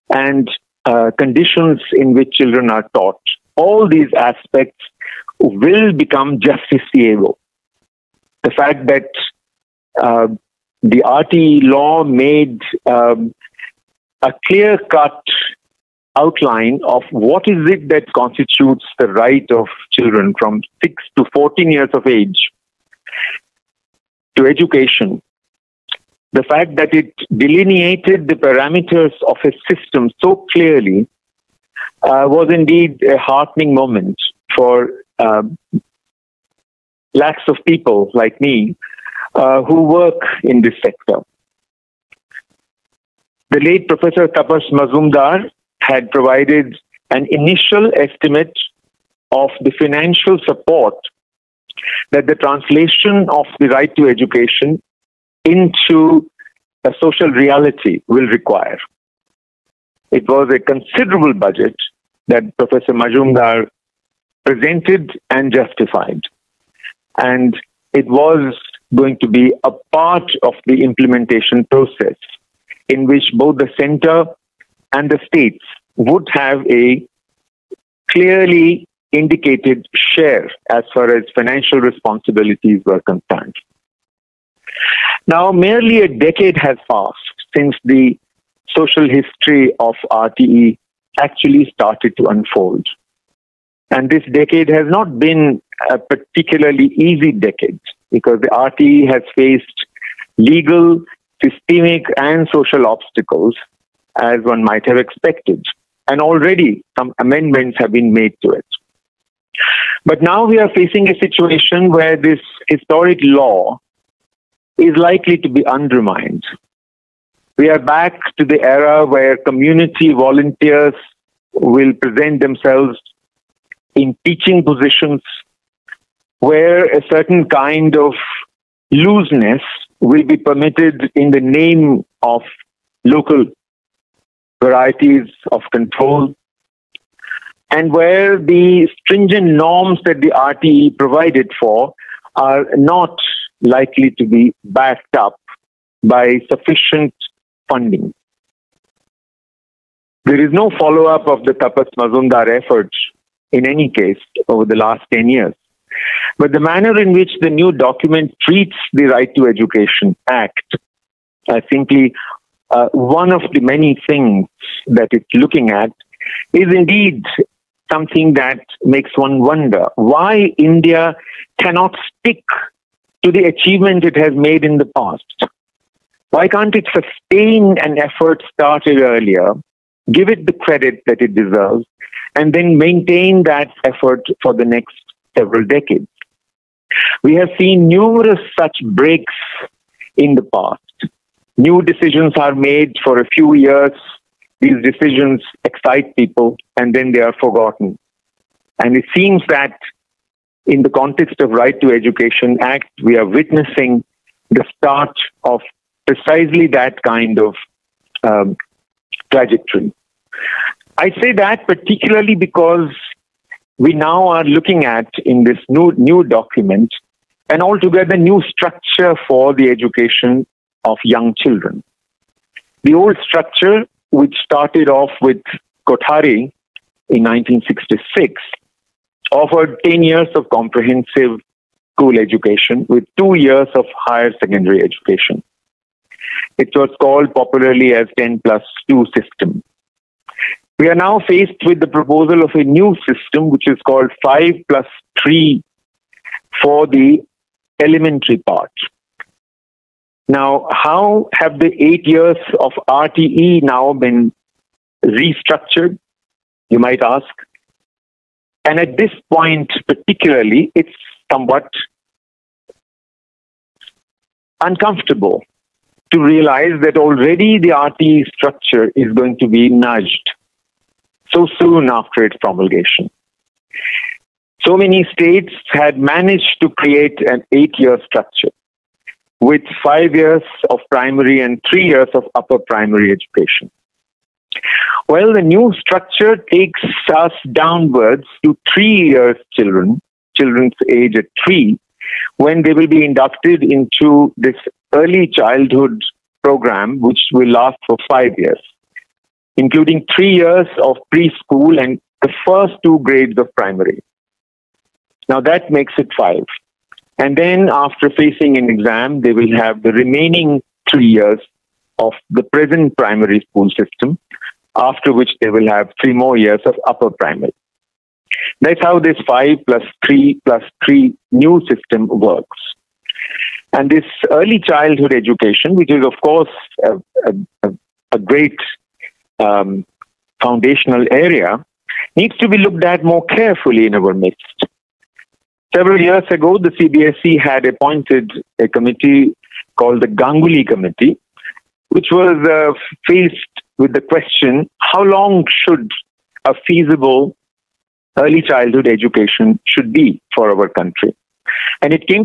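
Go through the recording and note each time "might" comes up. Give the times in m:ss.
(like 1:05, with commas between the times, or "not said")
1:44, 4:16.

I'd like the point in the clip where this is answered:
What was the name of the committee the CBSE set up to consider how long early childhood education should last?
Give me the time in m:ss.
5:40.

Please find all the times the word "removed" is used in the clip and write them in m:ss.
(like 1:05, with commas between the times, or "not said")
not said.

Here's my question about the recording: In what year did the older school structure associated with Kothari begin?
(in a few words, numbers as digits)
1966.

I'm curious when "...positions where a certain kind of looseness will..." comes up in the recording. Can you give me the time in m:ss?
2:04.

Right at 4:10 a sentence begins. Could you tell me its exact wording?
Now, how have the eight years of RTE now been restructured?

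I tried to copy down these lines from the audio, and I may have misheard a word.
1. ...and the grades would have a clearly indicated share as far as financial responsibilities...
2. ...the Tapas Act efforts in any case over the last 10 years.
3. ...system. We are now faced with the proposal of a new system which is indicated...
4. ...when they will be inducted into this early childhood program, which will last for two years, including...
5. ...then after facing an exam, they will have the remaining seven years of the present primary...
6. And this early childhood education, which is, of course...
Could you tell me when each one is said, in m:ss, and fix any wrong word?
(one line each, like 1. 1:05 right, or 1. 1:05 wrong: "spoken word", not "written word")
1. 1:14 wrong: "states", not "grades"
2. 2:31 wrong: "Majumdar", not "Act"
3. 3:59 wrong: "called", not "indicated"
4. 4:52 wrong: "five", not "two"
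5. 5:07 wrong: "three", not "seven"
6. 5:23 right.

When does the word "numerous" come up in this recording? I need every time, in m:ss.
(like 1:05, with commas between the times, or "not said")
3:07.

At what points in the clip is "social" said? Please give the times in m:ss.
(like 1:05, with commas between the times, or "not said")
0:57, 1:28, 1:42.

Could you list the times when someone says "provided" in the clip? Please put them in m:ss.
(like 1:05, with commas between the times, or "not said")
0:46, 2:20.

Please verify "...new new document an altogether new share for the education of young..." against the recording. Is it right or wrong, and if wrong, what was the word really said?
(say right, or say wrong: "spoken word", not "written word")
wrong: "structure", not "share".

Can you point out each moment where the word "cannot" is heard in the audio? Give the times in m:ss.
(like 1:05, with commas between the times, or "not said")
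2:51.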